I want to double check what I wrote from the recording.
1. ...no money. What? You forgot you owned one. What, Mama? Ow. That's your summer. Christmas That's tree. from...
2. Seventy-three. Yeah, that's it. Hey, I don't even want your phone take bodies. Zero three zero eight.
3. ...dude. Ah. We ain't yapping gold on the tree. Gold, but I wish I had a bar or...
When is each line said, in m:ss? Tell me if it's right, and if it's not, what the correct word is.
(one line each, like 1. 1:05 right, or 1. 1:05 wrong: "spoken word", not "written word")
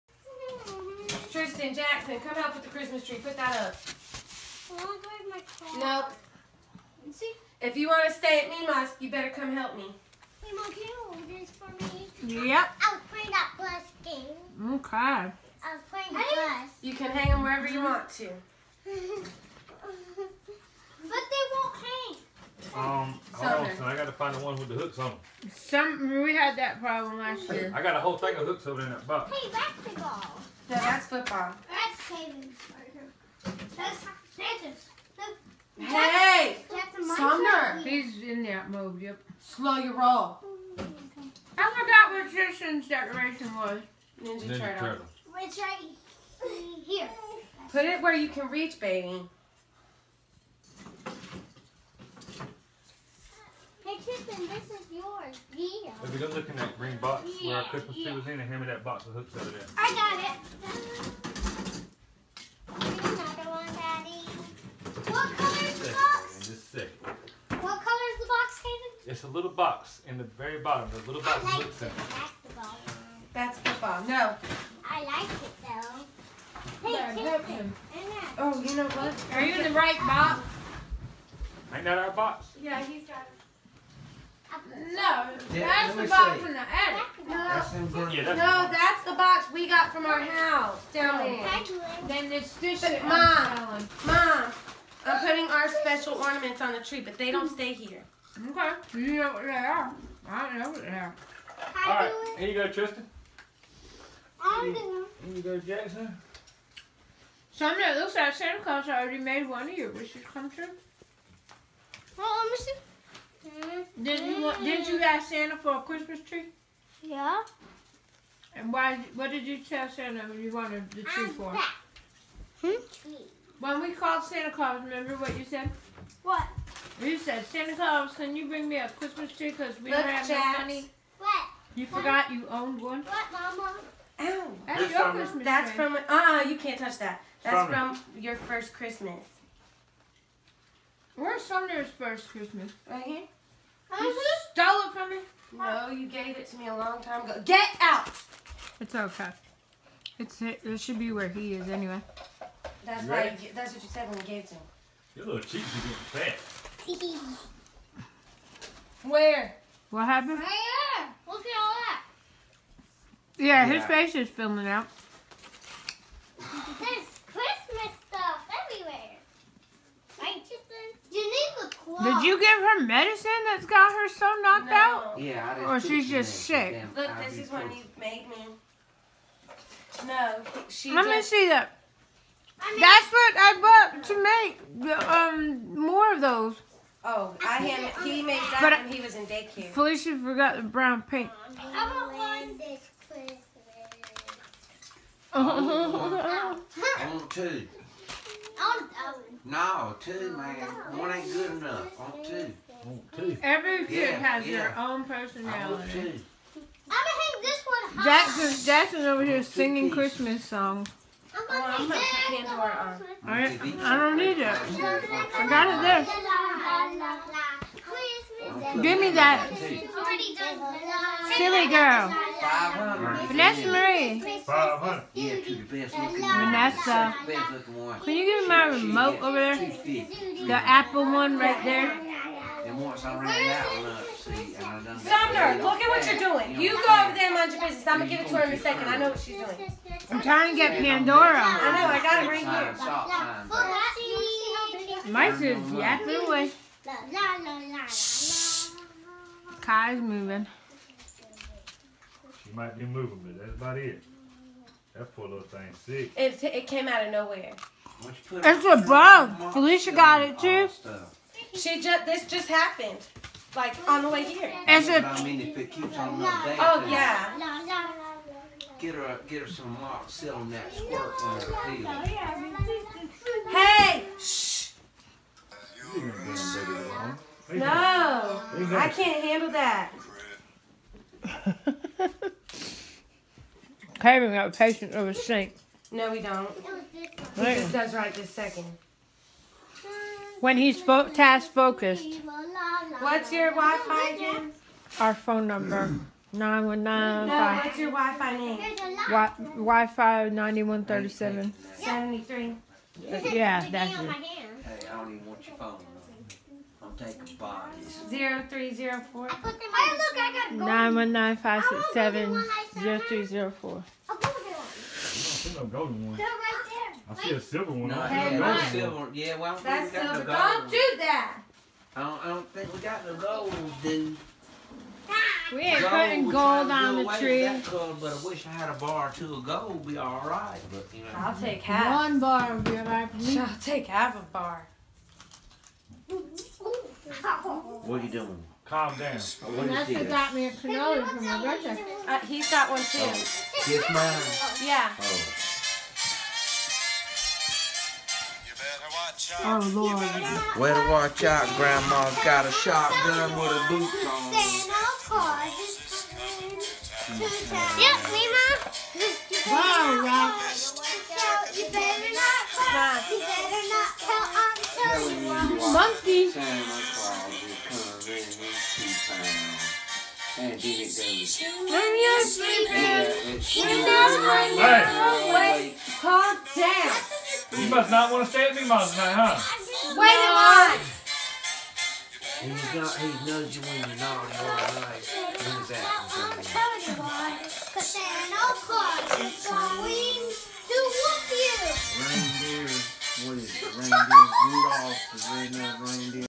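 1. 2:10 right
2. 5:01 wrong: "four", not "eight"
3. 5:23 wrong: "putting", not "yapping".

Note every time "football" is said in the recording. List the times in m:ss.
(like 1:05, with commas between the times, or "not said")
0:31, 1:13.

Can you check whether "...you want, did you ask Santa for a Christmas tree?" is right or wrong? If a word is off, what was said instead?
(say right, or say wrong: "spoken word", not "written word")
right.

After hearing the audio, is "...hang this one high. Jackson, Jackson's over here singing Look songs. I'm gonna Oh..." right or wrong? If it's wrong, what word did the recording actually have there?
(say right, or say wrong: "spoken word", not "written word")
wrong: "Christmas", not "Look".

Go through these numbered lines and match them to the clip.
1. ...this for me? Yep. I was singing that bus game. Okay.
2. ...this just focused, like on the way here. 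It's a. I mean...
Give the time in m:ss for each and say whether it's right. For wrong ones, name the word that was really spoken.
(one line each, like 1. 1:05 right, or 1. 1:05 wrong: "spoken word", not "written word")
1. 0:11 wrong: "playing", not "singing"
2. 4:22 wrong: "happened", not "focused".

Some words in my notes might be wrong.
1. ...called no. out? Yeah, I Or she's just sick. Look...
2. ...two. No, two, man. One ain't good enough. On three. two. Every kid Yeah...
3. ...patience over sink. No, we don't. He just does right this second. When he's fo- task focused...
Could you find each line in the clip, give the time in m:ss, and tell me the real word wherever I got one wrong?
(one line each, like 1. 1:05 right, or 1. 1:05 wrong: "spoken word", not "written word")
1. 2:54 wrong: "knocked", not "called"
2. 3:17 wrong: "two", not "three"
3. 4:44 right.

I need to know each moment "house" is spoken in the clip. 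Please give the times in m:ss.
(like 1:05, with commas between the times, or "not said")
1:30.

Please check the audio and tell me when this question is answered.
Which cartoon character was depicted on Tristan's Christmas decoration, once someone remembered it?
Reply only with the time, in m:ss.
0:44.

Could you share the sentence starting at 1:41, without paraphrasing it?
All right, here you go, Tristan.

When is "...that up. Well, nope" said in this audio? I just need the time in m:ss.
0:03.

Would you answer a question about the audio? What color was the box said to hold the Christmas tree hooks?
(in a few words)
green box.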